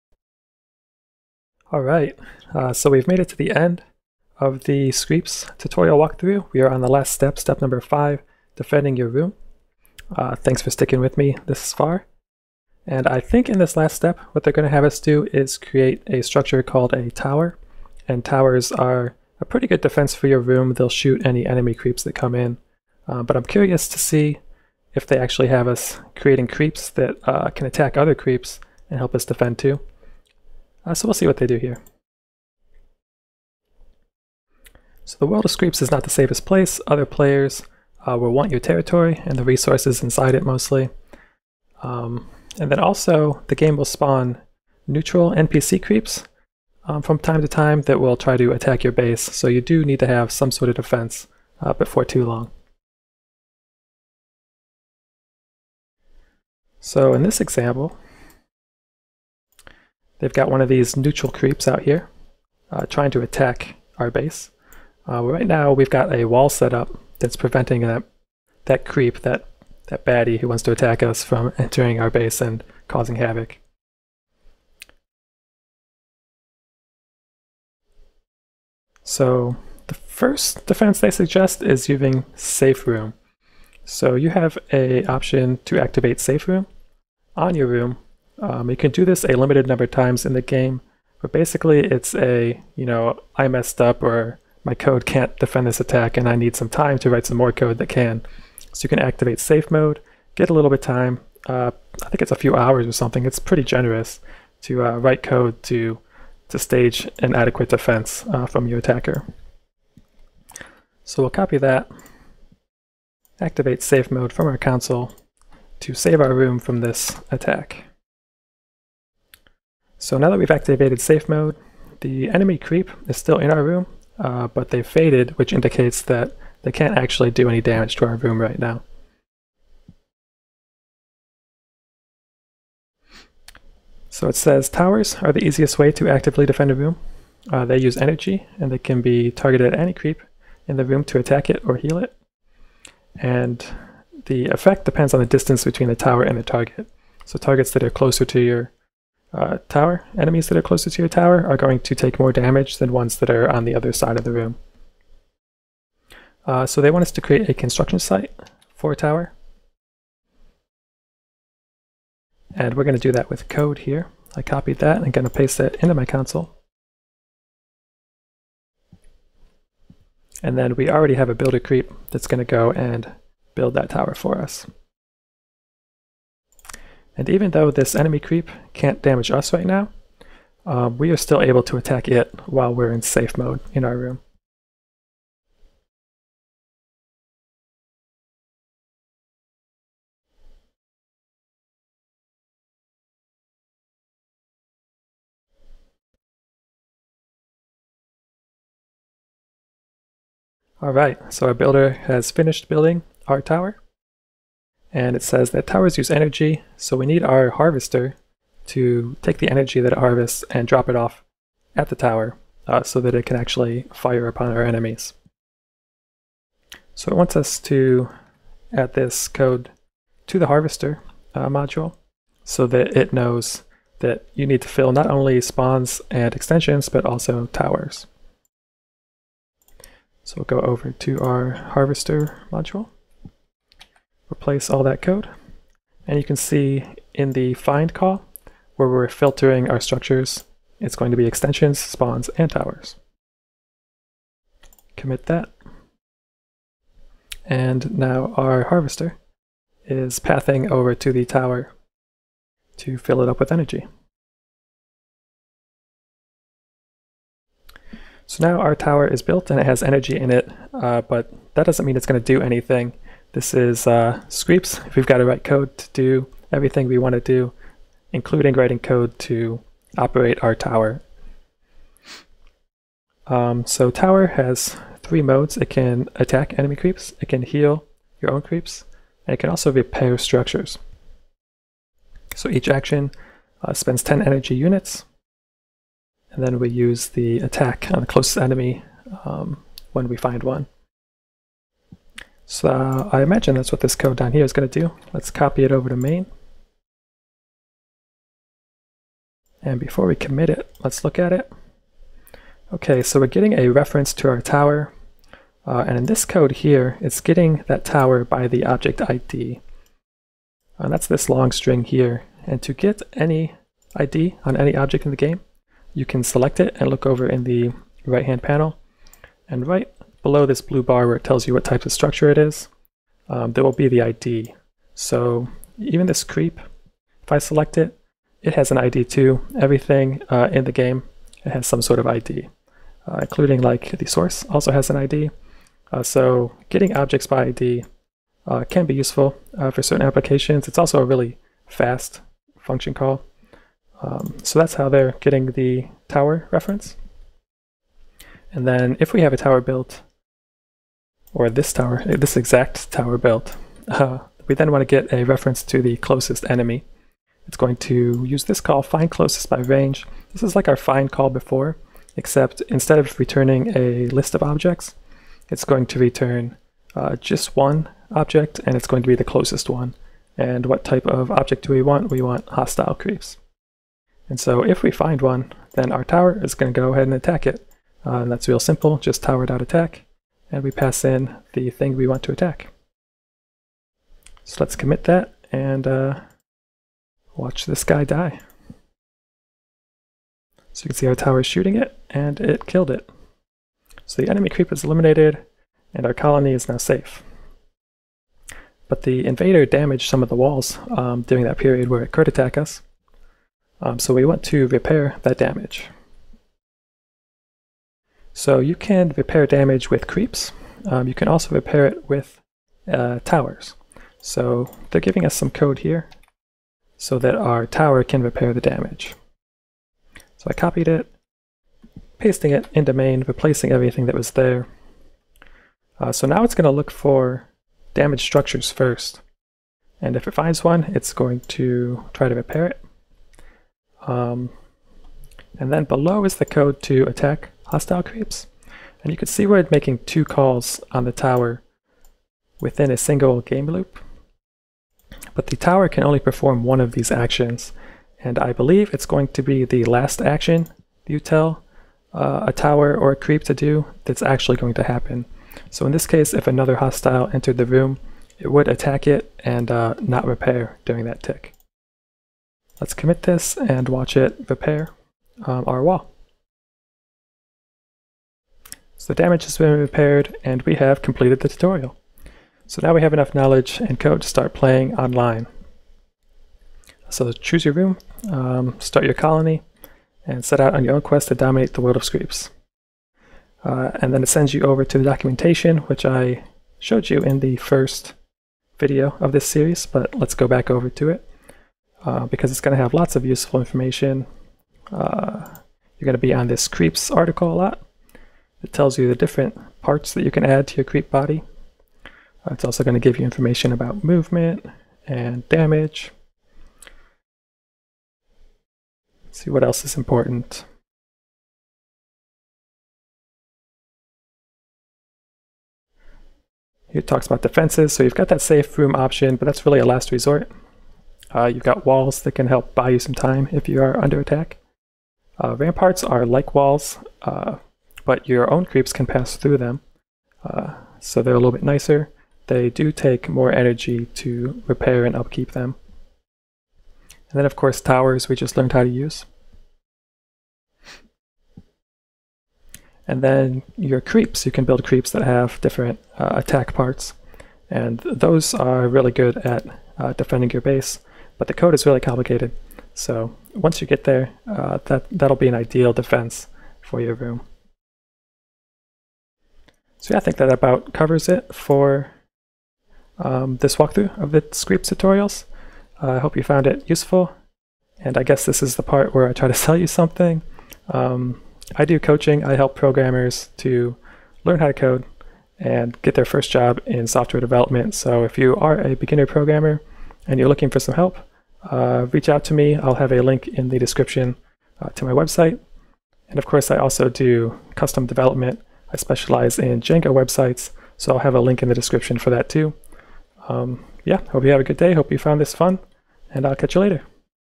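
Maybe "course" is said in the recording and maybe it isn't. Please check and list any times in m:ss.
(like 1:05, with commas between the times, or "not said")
8:57, 9:46.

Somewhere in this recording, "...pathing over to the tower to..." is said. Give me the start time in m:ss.
4:10.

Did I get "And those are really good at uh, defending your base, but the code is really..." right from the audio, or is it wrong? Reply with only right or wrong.
right.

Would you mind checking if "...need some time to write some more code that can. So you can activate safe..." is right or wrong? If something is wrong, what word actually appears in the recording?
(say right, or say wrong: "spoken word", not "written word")
right.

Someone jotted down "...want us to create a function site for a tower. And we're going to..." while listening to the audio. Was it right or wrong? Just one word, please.
wrong.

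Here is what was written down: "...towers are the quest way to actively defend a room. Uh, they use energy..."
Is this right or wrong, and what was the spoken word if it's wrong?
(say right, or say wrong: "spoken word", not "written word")
wrong: "easiest", not "quest".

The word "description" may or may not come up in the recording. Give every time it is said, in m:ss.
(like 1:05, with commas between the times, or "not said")
9:43, 9:51.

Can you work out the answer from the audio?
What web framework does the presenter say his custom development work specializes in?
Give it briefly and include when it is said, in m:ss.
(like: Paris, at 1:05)
Django, at 9:49.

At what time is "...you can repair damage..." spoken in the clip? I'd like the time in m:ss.
6:48.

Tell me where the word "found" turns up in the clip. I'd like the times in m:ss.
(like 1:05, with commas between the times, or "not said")
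9:26, 9:55.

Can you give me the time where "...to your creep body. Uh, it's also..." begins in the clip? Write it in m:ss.
8:20.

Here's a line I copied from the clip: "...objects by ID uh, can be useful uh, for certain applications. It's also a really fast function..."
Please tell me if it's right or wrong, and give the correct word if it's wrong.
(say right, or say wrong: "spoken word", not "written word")
right.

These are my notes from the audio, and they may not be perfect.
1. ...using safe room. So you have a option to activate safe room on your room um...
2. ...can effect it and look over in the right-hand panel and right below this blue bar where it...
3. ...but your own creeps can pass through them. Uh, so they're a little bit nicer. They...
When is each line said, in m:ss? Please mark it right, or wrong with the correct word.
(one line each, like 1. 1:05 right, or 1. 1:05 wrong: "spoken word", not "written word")
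1. 1:21 right
2. 5:16 wrong: "select", not "effect"
3. 8:48 right.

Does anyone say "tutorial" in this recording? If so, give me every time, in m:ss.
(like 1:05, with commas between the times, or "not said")
0:05, 7:51, 9:24.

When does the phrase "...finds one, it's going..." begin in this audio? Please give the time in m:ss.
7:10.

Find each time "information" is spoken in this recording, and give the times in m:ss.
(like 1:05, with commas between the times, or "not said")
8:13, 8:23.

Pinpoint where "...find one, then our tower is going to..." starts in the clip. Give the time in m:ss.
6:14.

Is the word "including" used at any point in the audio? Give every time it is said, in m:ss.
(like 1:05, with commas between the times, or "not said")
4:28, 5:33.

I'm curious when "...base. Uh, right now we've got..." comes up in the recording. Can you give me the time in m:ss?
1:04.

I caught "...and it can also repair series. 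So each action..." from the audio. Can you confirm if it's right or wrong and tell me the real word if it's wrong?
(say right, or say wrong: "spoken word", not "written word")
wrong: "structures", not "series".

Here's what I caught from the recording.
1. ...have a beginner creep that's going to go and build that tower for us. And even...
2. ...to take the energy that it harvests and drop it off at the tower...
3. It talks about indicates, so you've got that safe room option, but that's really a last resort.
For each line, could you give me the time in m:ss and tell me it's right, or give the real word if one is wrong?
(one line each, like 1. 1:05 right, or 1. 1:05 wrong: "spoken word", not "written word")
1. 2:51 wrong: "builder", not "beginner"
2. 3:28 right
3. 8:36 wrong: "defenses", not "indicates".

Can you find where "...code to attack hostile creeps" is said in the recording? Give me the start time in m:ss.
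7:16.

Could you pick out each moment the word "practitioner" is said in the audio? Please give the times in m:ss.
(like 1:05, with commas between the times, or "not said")
not said.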